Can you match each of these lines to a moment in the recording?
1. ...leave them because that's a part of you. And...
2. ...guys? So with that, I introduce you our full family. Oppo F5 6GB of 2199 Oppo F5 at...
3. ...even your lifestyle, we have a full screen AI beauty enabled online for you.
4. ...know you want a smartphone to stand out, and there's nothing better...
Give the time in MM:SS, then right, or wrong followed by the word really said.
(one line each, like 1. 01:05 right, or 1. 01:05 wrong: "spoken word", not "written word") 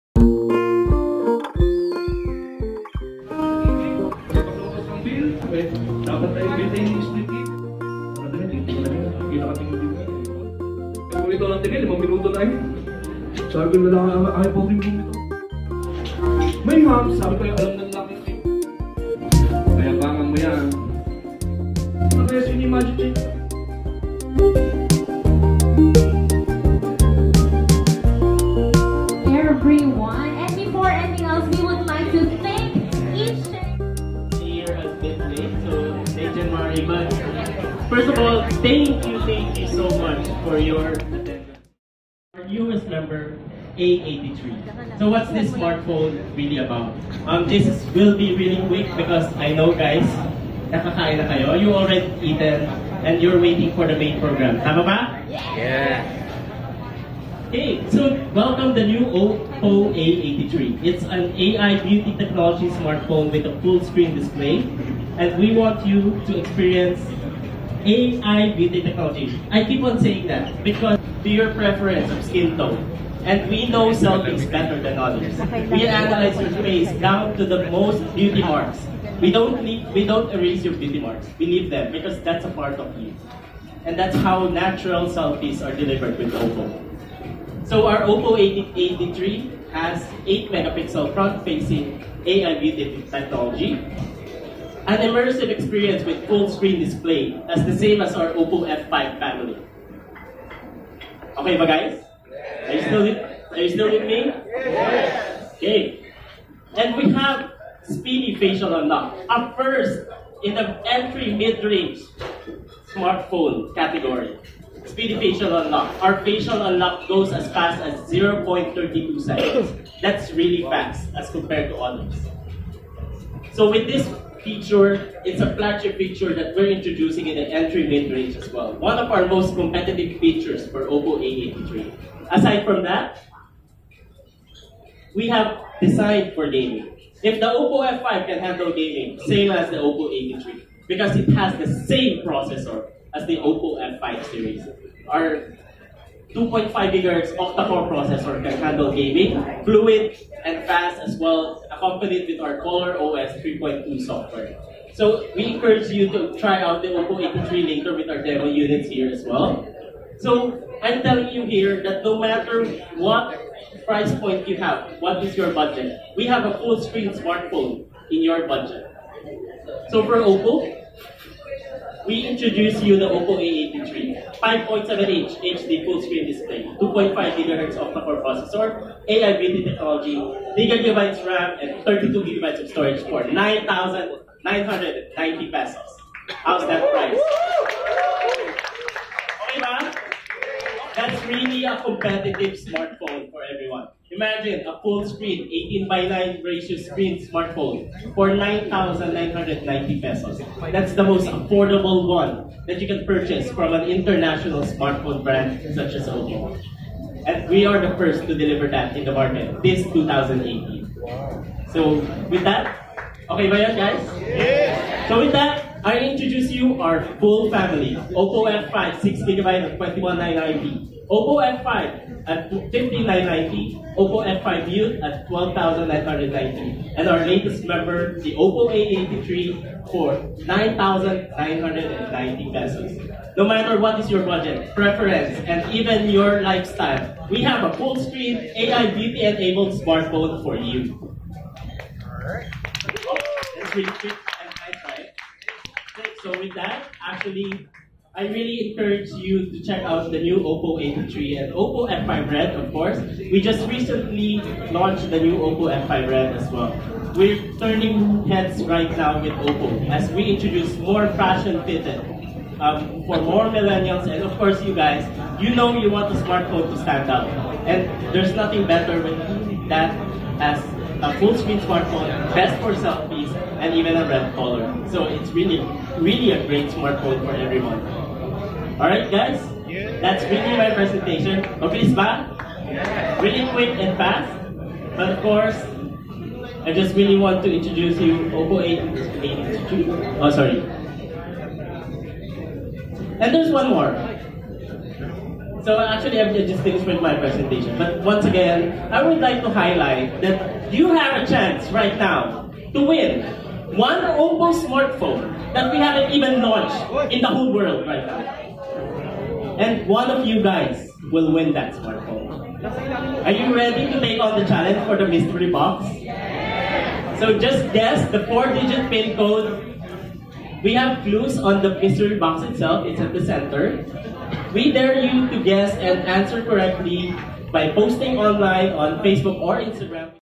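1. 01:21 right
2. 03:33 right
3. 03:55 wrong: "smartphone", not "online"
4. 04:25 right.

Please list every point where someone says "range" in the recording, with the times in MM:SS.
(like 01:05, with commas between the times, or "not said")
01:51, 02:07.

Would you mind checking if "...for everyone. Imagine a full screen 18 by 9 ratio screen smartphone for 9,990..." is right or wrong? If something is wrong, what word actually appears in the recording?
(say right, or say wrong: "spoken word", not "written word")
right.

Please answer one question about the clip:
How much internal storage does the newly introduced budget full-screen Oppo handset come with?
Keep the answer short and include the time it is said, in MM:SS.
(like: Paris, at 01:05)
32 gigabytes, at 03:01.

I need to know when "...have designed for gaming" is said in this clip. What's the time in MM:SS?
02:15.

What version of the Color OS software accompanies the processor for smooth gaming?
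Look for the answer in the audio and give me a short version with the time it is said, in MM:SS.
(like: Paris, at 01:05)
3.2, at 02:32.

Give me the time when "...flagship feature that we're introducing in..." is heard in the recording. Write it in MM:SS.
02:05.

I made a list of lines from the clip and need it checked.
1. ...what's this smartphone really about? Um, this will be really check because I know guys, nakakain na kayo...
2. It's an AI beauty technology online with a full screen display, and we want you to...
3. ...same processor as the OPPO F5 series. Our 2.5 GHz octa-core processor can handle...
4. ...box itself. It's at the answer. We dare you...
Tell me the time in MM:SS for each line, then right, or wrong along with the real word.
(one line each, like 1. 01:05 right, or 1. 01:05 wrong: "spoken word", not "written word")
1. 00:45 wrong: "quick", not "check"
2. 01:00 wrong: "smartphone", not "online"
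3. 02:21 right
4. 05:22 wrong: "center", not "answer".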